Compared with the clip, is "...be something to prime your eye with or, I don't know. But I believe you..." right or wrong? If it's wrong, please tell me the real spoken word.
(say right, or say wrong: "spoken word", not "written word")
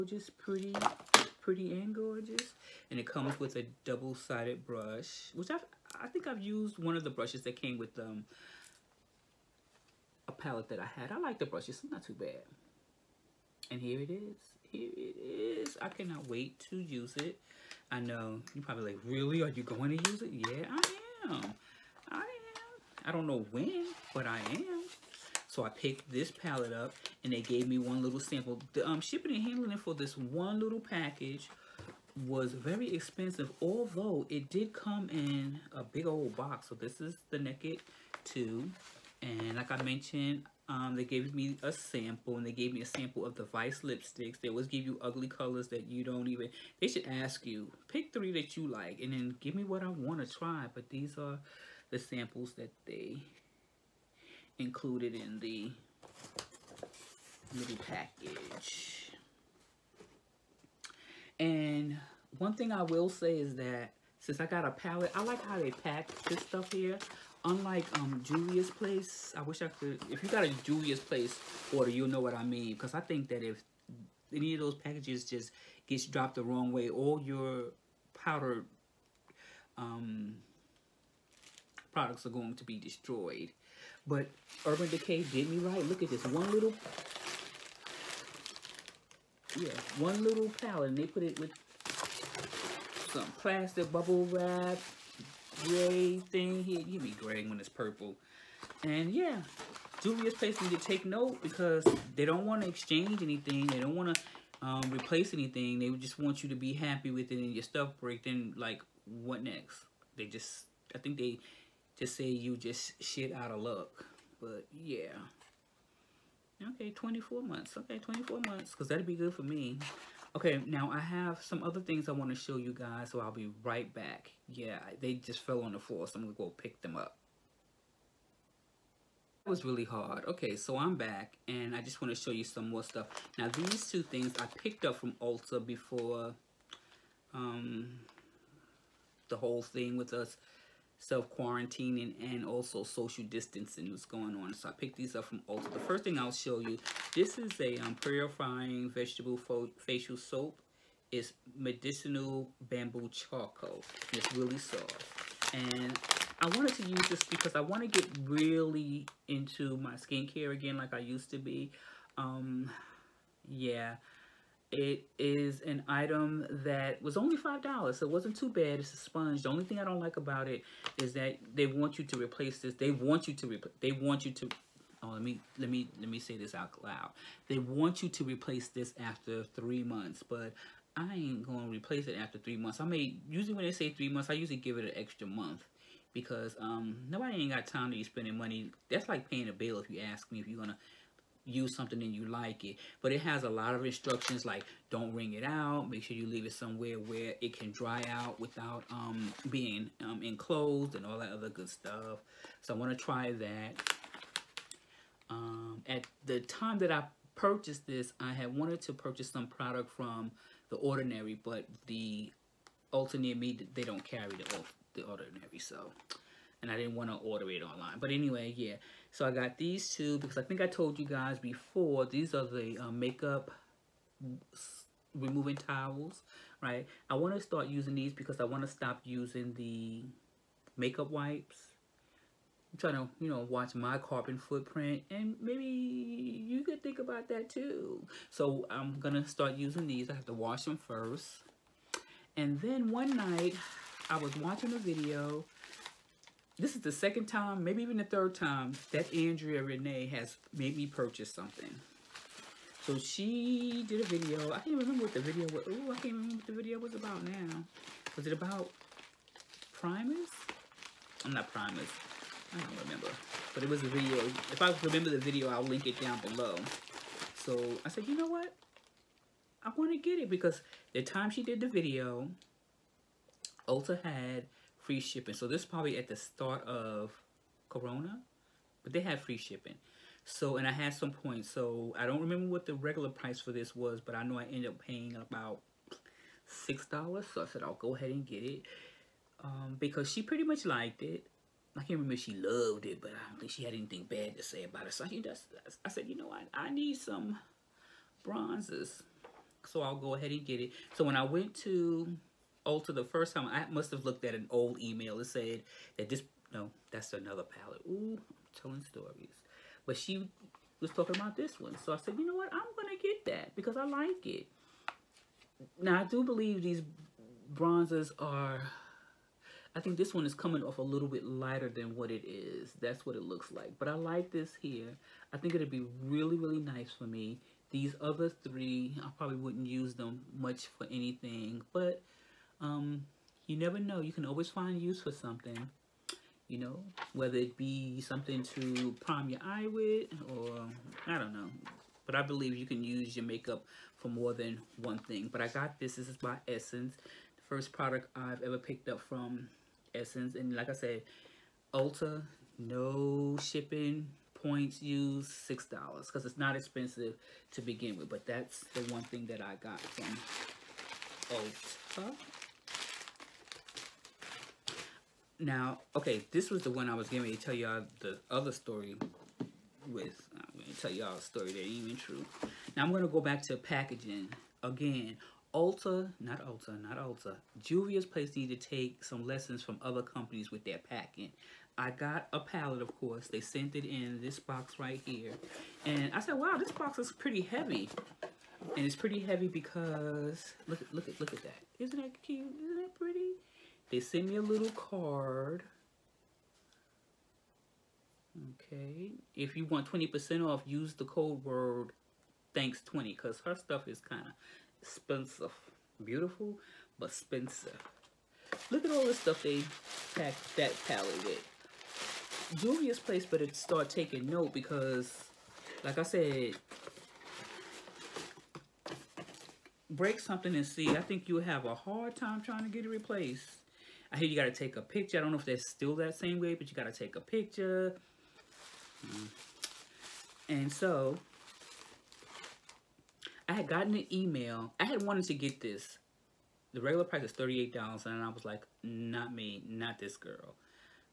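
right.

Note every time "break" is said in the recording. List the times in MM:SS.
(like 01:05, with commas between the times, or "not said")
01:47, 06:59.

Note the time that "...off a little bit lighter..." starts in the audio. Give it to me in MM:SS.
05:20.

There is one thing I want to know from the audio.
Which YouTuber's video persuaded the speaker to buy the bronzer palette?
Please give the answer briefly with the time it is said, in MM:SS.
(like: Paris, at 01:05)
Andrea Renee, at 04:09.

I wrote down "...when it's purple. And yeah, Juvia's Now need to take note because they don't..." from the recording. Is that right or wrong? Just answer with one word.
wrong.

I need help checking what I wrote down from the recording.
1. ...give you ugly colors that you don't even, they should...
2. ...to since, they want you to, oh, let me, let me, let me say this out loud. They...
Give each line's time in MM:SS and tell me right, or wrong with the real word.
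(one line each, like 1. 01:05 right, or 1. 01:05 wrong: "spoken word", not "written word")
1. 00:44 right
2. 02:53 wrong: "replace", not "since".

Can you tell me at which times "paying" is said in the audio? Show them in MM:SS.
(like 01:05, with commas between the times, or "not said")
03:09, 04:44.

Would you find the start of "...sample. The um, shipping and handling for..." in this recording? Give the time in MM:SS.
00:28.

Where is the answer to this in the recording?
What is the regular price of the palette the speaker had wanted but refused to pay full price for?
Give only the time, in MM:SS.
07:17.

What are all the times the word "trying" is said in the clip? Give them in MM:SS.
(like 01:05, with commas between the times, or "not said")
03:52, 07:02.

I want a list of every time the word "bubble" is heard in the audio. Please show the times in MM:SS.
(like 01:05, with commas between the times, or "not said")
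01:33.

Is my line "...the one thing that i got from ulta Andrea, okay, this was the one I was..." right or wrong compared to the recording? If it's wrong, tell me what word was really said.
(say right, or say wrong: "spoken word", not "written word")
wrong: "Now", not "Andrea".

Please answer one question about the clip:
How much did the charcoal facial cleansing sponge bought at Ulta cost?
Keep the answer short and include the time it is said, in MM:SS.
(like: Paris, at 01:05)
$5, at 02:47.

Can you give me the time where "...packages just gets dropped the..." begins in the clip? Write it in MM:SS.
01:14.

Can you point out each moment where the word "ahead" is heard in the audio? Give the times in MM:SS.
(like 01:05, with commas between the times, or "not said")
04:47, 05:00.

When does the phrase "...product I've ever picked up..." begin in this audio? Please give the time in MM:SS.
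05:47.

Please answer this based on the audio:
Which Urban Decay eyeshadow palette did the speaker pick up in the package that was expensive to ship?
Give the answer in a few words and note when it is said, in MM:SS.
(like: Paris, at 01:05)
Naked 2, at 00:37.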